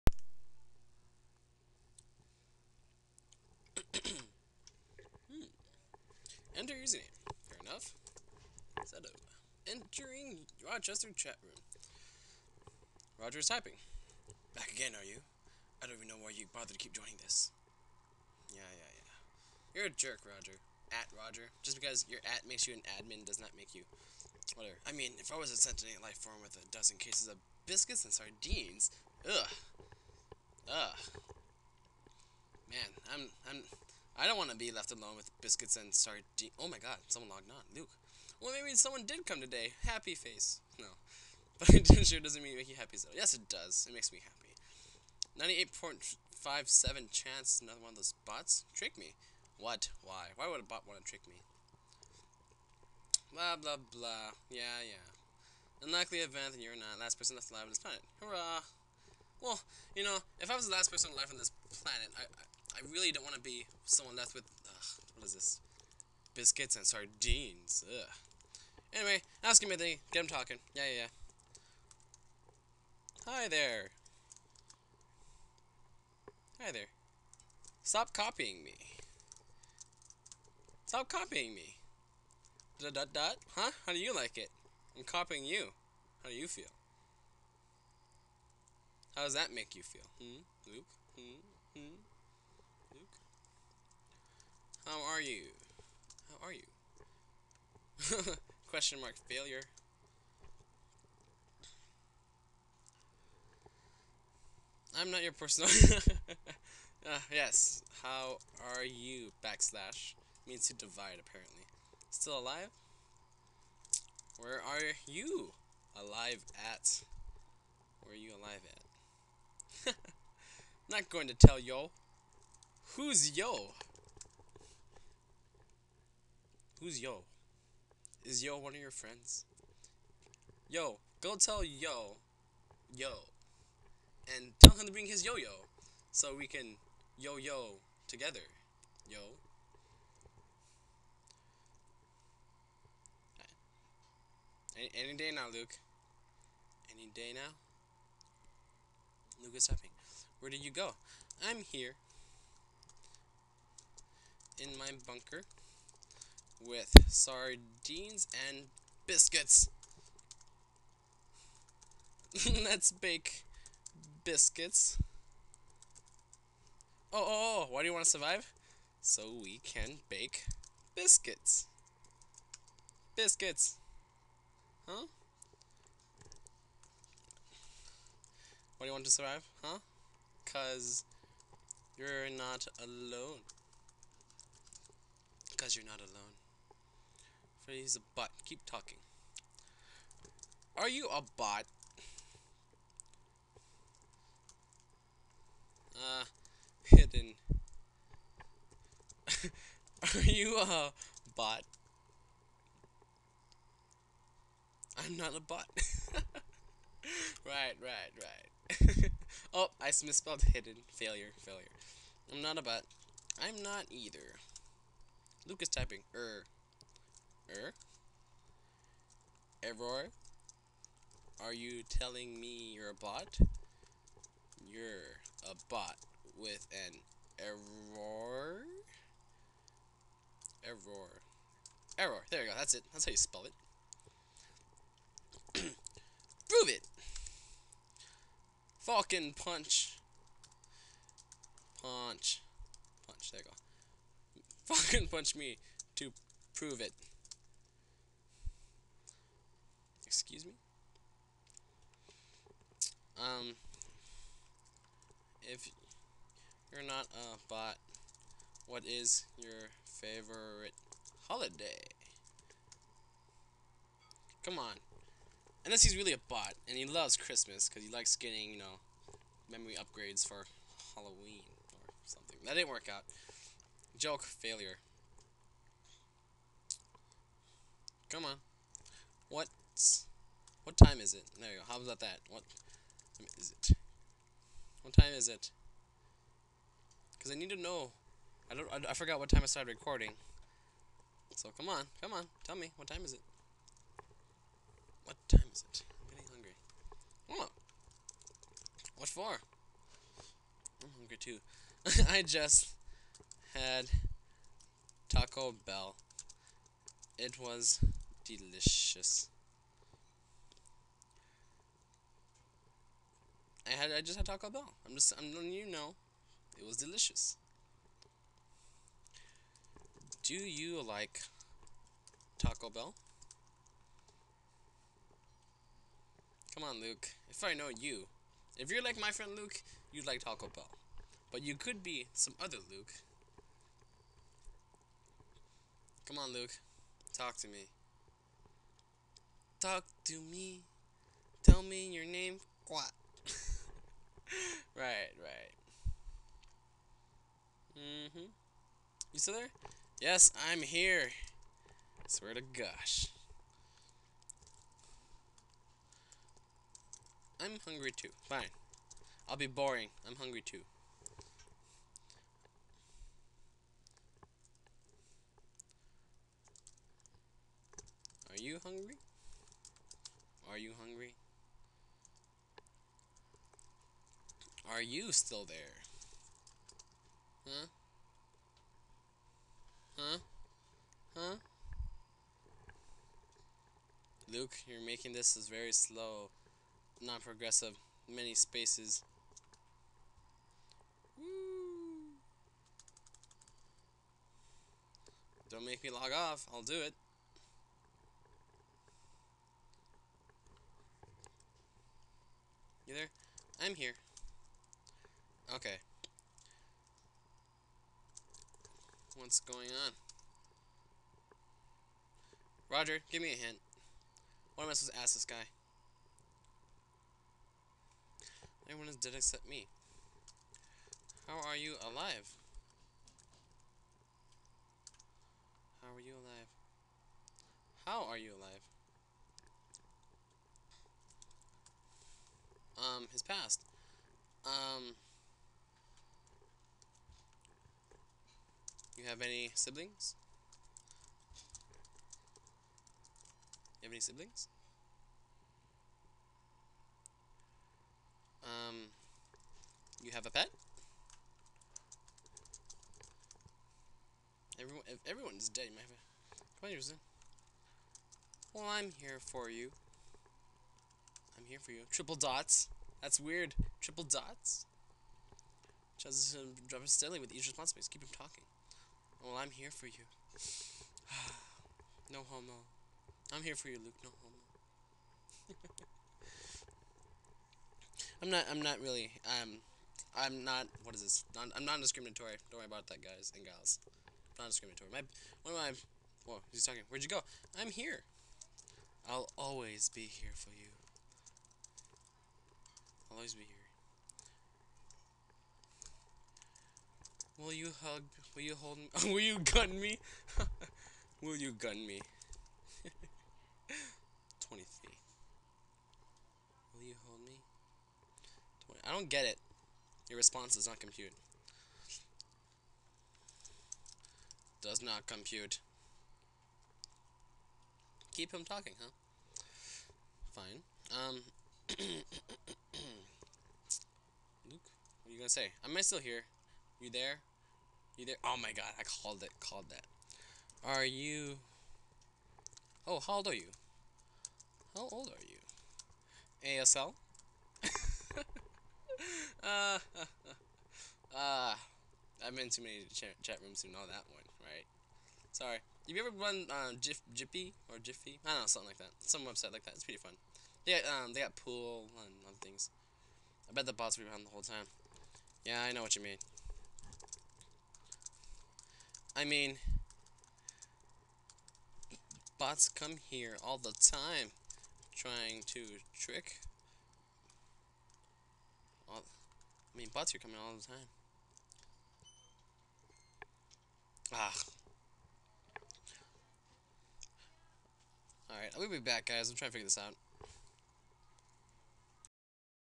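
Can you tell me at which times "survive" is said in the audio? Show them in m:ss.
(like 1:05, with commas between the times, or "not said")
2:48, 2:59.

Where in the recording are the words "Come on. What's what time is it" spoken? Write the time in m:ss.
4:38.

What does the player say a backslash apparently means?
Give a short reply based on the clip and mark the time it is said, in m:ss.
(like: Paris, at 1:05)
To divide, at 1:50.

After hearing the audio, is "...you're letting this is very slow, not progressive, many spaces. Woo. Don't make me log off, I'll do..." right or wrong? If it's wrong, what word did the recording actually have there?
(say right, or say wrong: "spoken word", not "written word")
wrong: "making", not "letting".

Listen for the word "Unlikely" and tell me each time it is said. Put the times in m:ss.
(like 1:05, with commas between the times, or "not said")
0:55.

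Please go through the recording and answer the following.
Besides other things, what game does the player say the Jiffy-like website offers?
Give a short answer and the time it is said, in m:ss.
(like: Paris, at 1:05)
Pool, at 9:11.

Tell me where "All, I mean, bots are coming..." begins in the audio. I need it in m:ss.
9:28.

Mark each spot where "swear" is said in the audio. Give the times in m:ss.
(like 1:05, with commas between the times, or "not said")
5:52.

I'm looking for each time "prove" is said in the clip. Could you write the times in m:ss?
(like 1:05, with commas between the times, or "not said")
3:55, 4:06.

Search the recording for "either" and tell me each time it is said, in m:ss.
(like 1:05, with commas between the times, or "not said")
3:33, 8:47.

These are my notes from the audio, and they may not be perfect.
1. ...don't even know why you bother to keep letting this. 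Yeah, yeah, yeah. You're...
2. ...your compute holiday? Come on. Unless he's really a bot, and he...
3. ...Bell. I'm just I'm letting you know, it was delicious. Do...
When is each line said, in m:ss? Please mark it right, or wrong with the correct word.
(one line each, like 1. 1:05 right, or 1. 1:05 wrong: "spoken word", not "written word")
1. 0:15 wrong: "joining", not "letting"
2. 4:19 wrong: "favorite", not "compute"
3. 5:14 right.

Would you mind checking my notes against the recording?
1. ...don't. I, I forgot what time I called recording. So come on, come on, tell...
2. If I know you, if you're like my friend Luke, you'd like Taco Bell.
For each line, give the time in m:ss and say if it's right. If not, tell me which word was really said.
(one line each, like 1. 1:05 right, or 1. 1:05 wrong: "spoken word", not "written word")
1. 4:48 wrong: "started", not "called"
2. 5:27 right.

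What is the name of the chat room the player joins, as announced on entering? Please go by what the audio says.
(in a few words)
Rochester.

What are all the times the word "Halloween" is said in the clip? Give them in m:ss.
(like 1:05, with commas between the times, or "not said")
4:30.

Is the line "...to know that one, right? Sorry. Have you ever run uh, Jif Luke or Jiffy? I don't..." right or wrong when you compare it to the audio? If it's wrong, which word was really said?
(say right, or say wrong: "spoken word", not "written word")
wrong: "Jiffy", not "Luke".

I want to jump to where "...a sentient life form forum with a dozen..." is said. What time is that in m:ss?
0:25.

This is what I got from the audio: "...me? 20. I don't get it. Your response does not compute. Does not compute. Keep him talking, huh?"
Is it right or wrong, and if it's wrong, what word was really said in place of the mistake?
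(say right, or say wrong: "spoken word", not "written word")
right.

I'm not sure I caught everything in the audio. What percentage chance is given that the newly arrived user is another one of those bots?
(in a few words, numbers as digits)
98.57.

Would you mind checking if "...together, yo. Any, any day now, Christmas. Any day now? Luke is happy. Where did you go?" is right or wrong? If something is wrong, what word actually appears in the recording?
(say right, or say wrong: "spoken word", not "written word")
wrong: "Luke", not "Christmas".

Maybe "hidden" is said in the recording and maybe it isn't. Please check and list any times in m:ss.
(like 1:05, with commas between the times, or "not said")
3:16, 3:30.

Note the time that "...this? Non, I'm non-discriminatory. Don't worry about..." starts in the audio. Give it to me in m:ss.
8:01.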